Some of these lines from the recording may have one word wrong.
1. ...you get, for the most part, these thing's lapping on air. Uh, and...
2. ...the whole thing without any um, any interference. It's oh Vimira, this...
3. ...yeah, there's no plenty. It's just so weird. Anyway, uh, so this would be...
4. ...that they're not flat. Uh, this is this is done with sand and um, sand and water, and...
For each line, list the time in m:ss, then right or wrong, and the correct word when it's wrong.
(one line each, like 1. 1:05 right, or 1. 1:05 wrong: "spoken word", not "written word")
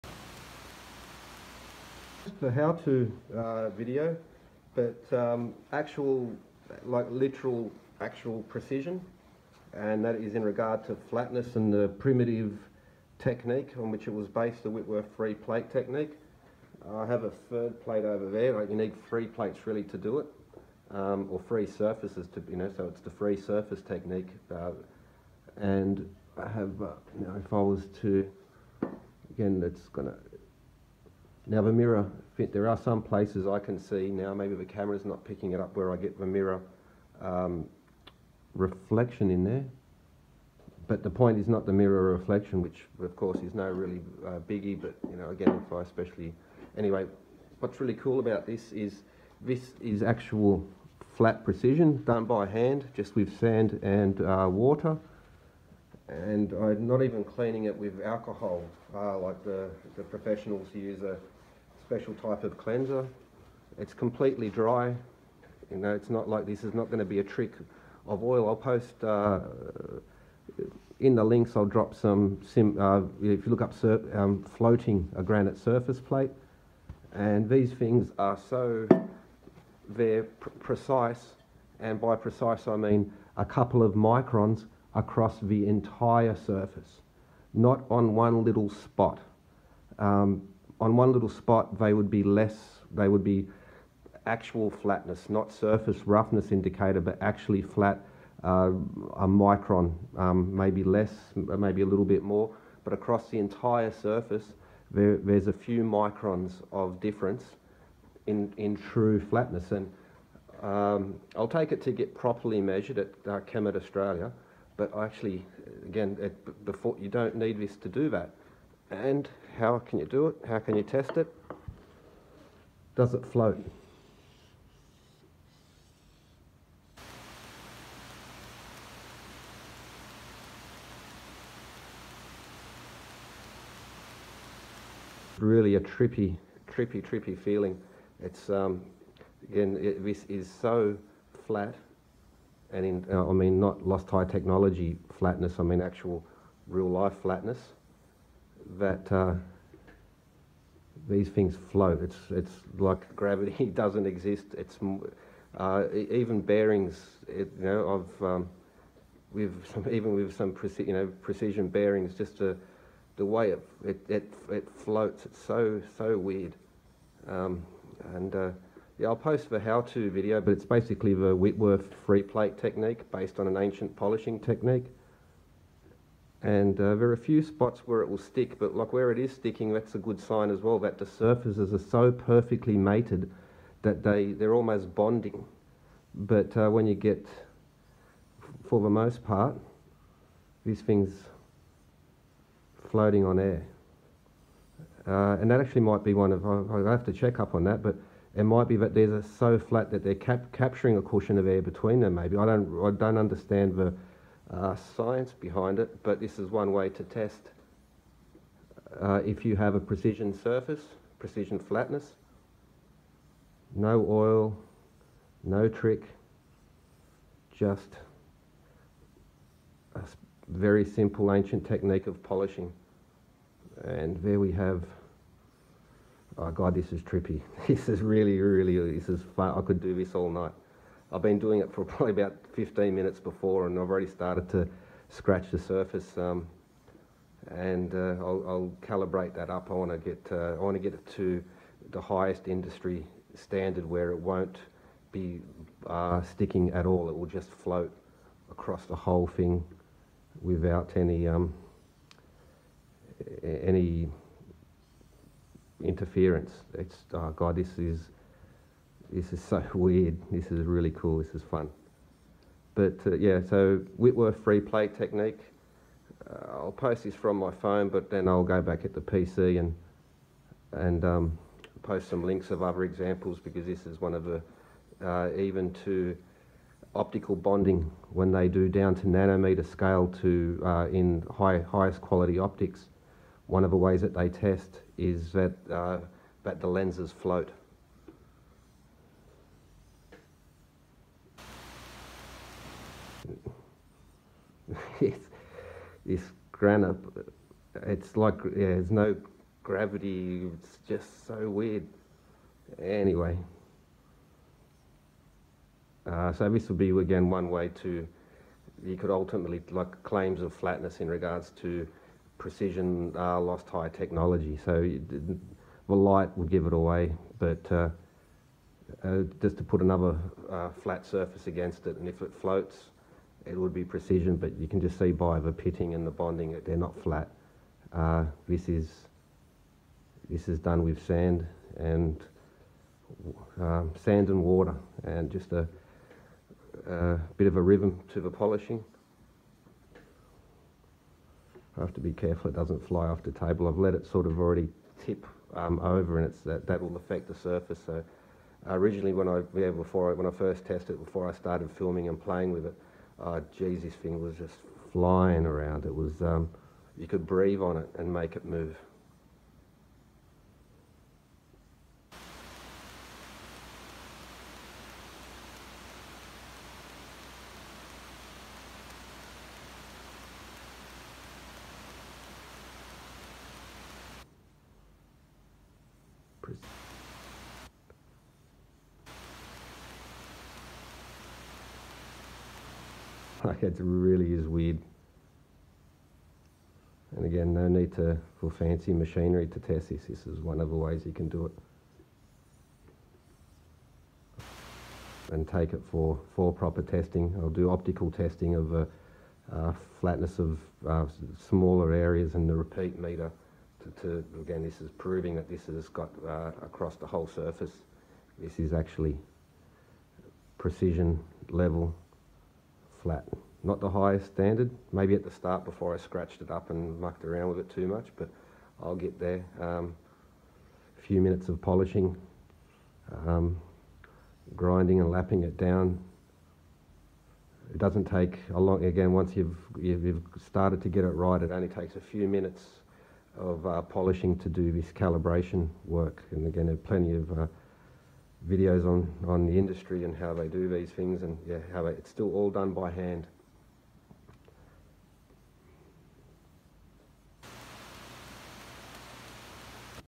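1. 3:06 wrong: "floating", not "lapping"
2. 4:08 wrong: "God", not "Vimira"
3. 4:58 wrong: "gravity", not "plenty"
4. 5:26 right.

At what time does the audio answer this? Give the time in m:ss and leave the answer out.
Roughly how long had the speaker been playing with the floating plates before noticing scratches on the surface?
3:52.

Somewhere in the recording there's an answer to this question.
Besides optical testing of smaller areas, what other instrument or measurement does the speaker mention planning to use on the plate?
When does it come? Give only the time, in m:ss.
6:42.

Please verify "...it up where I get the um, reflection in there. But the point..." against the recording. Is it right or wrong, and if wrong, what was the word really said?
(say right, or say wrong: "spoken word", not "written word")
right.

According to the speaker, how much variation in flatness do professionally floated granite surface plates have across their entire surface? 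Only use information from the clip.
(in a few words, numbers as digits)
a couple of microns.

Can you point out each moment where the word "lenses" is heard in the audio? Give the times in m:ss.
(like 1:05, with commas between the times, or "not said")
4:46.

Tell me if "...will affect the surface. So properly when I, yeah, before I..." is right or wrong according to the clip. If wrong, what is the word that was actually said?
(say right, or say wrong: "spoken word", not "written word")
wrong: "originally", not "properly".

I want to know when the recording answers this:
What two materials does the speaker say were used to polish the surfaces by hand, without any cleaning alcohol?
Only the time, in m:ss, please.
0:53.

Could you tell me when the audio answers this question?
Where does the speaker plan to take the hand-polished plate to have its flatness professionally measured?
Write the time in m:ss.
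1:53.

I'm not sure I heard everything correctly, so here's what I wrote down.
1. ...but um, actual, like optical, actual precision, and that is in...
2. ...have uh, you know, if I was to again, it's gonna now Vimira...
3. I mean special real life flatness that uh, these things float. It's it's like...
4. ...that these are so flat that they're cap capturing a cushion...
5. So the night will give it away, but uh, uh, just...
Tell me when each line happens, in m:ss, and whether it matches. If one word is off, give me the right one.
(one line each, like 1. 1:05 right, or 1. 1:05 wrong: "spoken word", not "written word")
1. 0:04 wrong: "literal", not "optical"
2. 0:26 right
3. 2:25 wrong: "actual", not "special"
4. 3:18 right
5. 5:14 wrong: "light", not "night".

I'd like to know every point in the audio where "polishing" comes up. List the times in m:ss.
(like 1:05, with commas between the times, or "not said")
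2:53, 3:42, 5:38, 7:01, 7:13.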